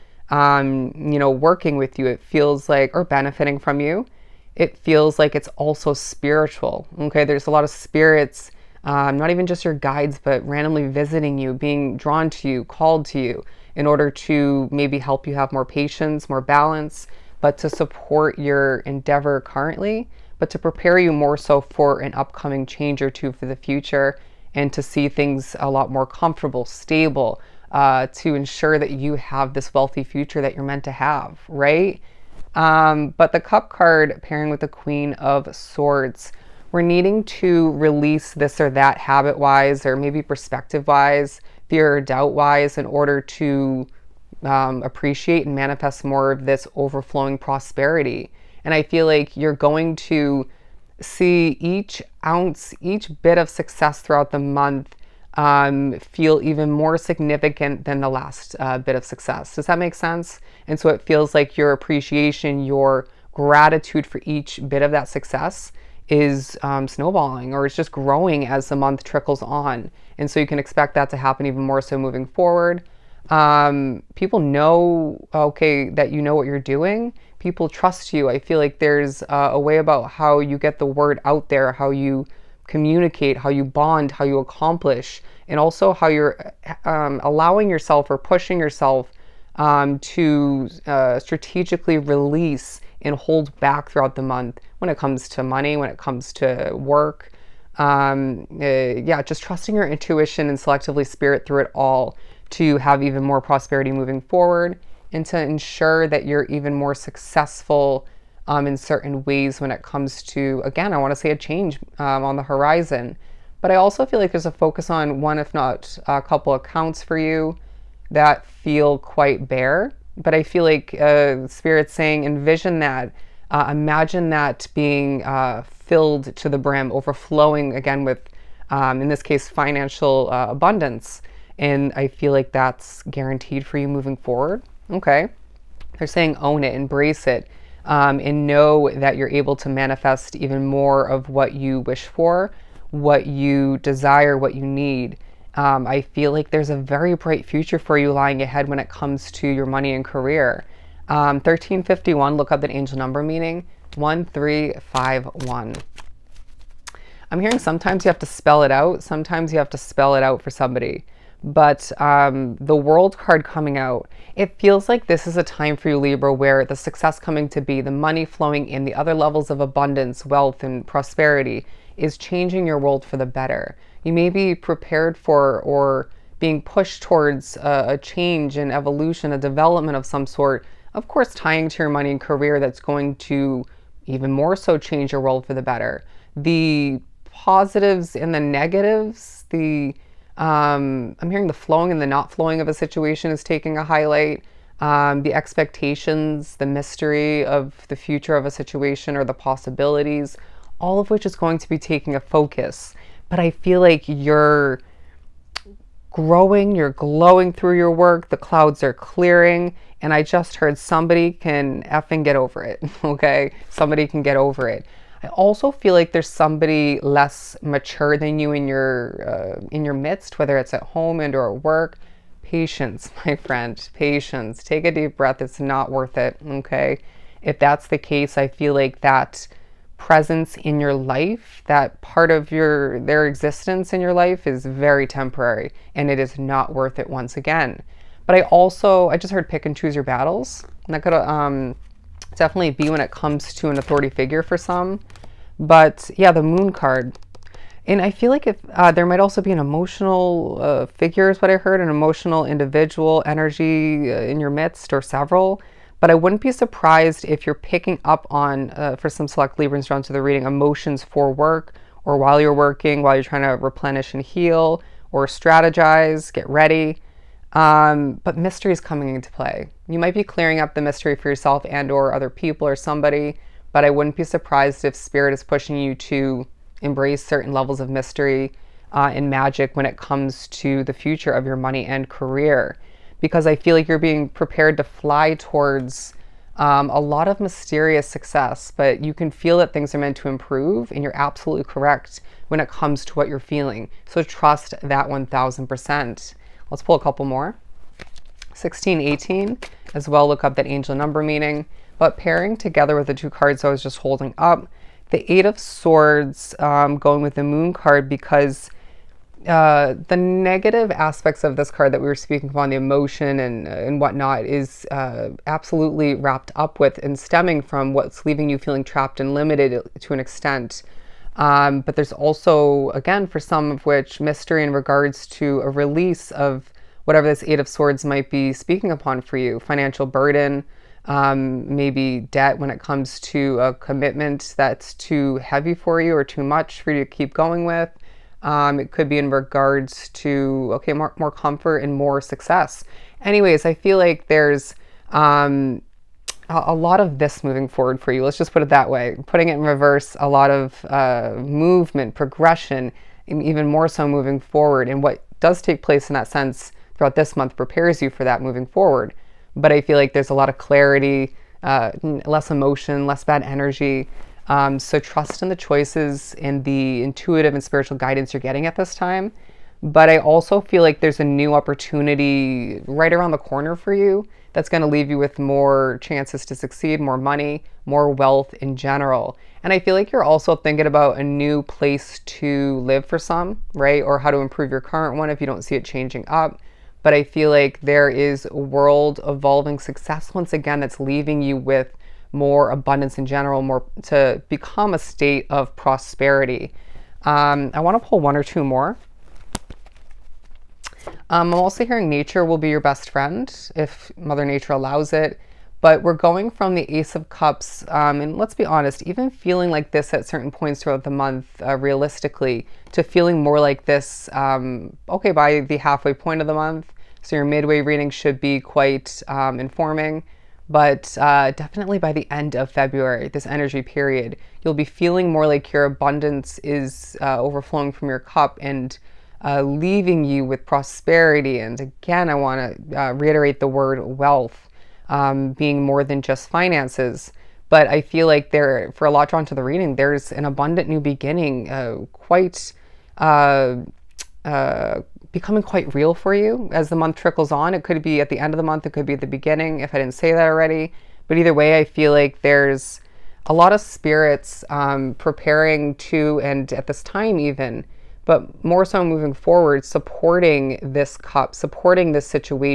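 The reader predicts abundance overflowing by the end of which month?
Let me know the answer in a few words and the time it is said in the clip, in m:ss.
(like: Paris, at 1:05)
February, at 7:02.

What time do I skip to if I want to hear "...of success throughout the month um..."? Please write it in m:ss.
0:53.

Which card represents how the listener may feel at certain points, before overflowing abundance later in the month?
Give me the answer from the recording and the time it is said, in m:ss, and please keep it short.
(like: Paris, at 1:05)
Ace of Cups, at 6:46.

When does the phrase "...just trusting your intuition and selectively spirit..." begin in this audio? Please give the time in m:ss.
1:39.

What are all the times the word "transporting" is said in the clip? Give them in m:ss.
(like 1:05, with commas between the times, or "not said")
not said.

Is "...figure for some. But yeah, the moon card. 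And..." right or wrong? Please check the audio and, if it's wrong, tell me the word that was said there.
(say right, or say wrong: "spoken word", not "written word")
right.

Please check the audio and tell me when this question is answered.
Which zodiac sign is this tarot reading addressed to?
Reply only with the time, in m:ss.
2:45.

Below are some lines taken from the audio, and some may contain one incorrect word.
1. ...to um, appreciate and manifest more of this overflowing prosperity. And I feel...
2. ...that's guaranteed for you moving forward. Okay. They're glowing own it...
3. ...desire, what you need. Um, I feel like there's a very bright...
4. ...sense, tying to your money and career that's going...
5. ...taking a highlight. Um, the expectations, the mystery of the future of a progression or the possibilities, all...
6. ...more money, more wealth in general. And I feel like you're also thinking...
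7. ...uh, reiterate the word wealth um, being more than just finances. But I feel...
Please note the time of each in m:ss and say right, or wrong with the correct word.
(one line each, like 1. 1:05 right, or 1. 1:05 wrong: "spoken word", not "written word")
1. 0:43 right
2. 2:12 wrong: "saying", not "glowing"
3. 2:23 right
4. 3:01 wrong: "course", not "sense"
5. 3:13 wrong: "situation", not "progression"
6. 6:16 right
7. 7:12 right.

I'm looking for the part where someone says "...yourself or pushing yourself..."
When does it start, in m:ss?
1:27.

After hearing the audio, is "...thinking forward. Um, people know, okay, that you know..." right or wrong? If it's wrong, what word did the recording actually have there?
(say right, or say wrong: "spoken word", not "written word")
wrong: "moving", not "thinking".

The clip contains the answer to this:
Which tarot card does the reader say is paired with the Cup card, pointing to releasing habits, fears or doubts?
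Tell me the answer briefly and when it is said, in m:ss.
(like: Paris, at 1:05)
Queen of Swords, at 0:34.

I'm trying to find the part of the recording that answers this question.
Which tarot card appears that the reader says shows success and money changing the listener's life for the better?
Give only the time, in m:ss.
2:42.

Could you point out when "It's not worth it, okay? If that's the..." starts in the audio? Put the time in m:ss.
3:45.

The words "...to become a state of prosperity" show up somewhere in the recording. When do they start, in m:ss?
6:34.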